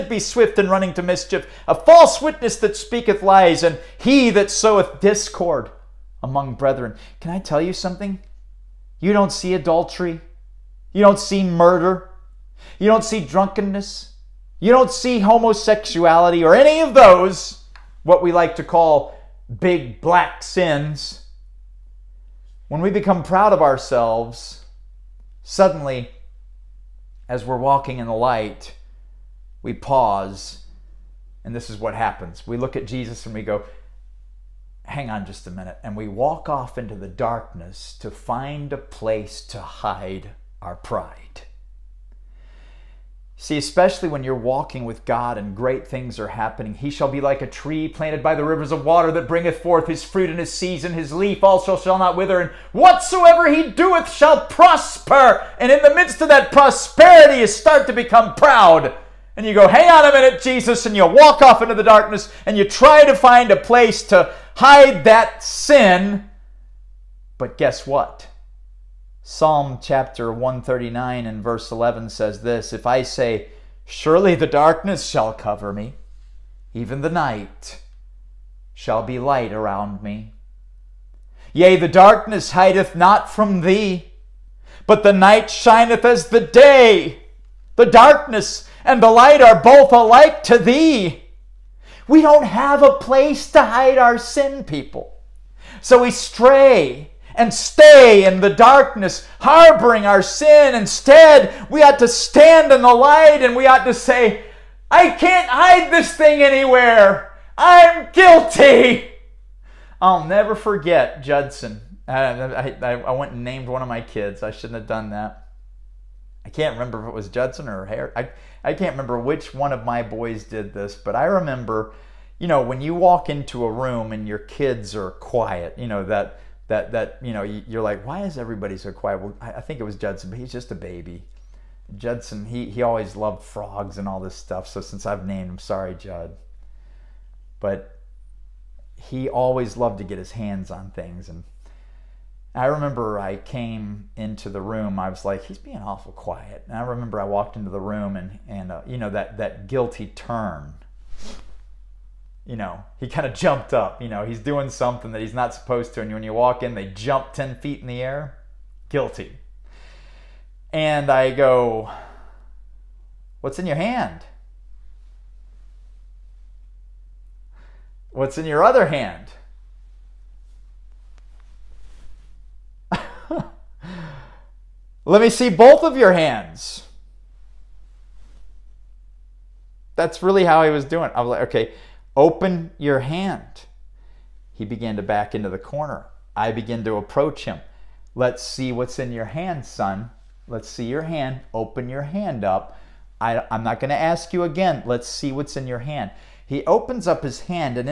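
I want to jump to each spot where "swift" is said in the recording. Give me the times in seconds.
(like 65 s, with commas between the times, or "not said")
0 s.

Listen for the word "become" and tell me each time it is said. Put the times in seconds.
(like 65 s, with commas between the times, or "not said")
22 s, 57 s.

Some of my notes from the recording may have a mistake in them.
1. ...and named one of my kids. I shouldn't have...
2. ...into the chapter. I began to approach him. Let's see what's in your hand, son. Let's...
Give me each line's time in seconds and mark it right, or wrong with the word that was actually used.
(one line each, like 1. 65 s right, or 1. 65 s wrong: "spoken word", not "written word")
1. 113 s right
2. 185 s wrong: "corner", not "chapter".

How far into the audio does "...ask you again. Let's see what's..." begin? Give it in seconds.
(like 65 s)
193 s.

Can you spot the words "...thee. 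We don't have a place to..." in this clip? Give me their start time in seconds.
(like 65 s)
90 s.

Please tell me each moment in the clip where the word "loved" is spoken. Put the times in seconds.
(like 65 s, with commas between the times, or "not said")
133 s, 139 s.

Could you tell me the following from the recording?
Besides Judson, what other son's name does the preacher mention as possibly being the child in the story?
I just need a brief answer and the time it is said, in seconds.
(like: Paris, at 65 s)
Harry, at 117 s.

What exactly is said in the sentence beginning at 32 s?
We look at Jesus and we go, Hang on just a minute.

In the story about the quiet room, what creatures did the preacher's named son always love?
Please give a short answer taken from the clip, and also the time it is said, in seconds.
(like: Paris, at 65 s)
Frogs, at 133 s.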